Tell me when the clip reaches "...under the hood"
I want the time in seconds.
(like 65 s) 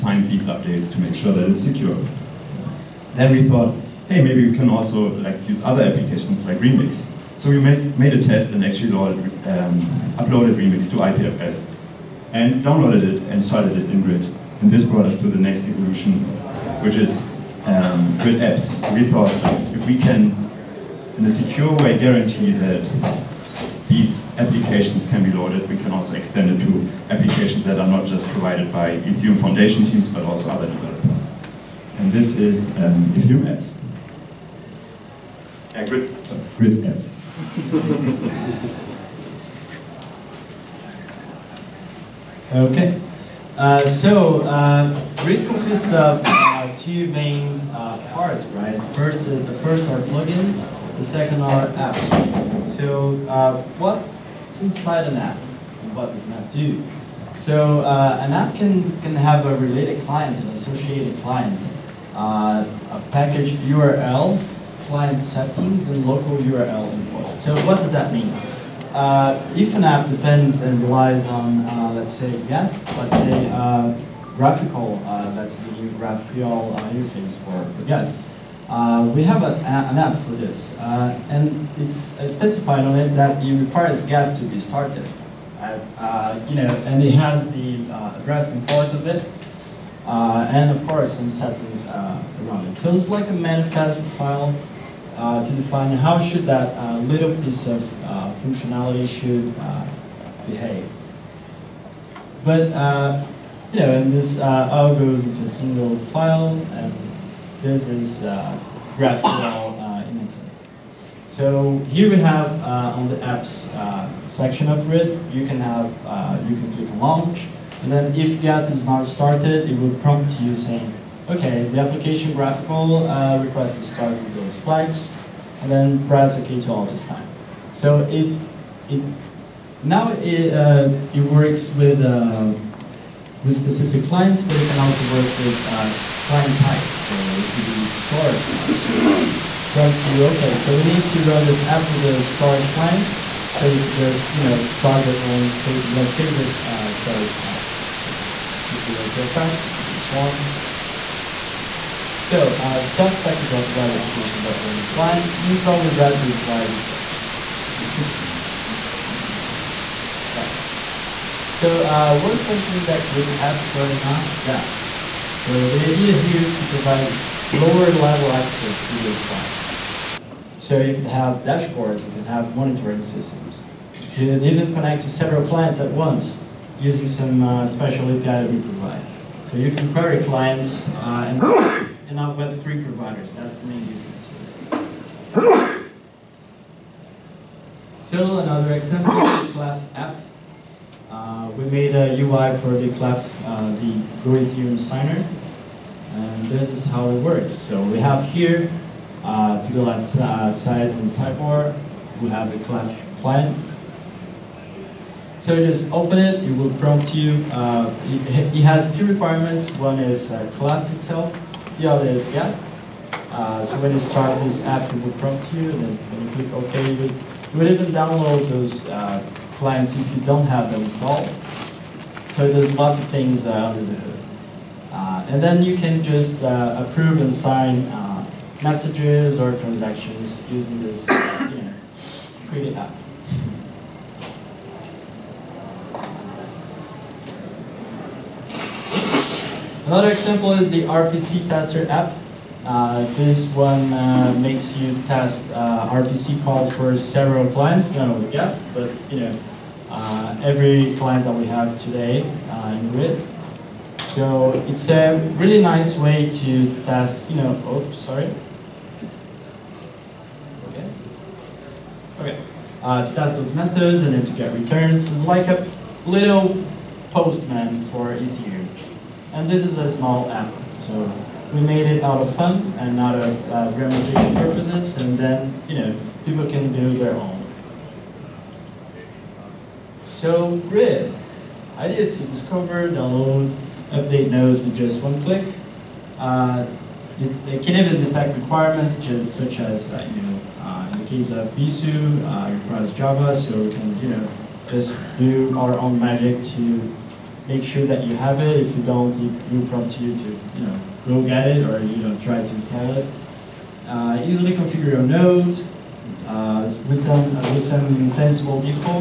223 s.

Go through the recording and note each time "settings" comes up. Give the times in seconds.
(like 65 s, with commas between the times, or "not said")
65 s, 91 s.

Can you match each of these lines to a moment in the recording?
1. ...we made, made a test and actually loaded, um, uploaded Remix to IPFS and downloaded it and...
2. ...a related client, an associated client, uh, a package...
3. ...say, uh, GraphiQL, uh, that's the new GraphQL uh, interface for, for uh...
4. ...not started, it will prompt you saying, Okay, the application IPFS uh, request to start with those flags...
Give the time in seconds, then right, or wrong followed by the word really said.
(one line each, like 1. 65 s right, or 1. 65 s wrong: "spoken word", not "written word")
1. 7 s right
2. 59 s right
3. 73 s right
4. 118 s wrong: "GraphiQL", not "IPFS".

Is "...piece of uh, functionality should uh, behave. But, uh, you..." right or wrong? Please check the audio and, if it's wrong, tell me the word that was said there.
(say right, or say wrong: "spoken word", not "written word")
right.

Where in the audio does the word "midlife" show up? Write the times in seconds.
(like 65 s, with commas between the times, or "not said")
not said.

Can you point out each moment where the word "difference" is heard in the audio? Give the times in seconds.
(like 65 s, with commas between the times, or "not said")
183 s.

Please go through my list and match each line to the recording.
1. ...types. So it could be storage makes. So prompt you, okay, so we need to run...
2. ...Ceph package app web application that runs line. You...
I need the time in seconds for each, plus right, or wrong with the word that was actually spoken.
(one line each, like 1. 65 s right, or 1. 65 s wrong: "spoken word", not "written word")
1. 136 s wrong: "types", not "makes"
2. 152 s right.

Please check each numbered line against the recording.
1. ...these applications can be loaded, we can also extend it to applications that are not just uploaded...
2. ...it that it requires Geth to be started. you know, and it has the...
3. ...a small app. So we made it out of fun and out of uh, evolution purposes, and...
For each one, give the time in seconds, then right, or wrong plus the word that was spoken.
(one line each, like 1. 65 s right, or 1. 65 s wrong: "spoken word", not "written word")
1. 23 s wrong: "provided", not "uploaded"
2. 82 s right
3. 269 s wrong: "demonstration", not "evolution".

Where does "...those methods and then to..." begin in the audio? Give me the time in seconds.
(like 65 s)
263 s.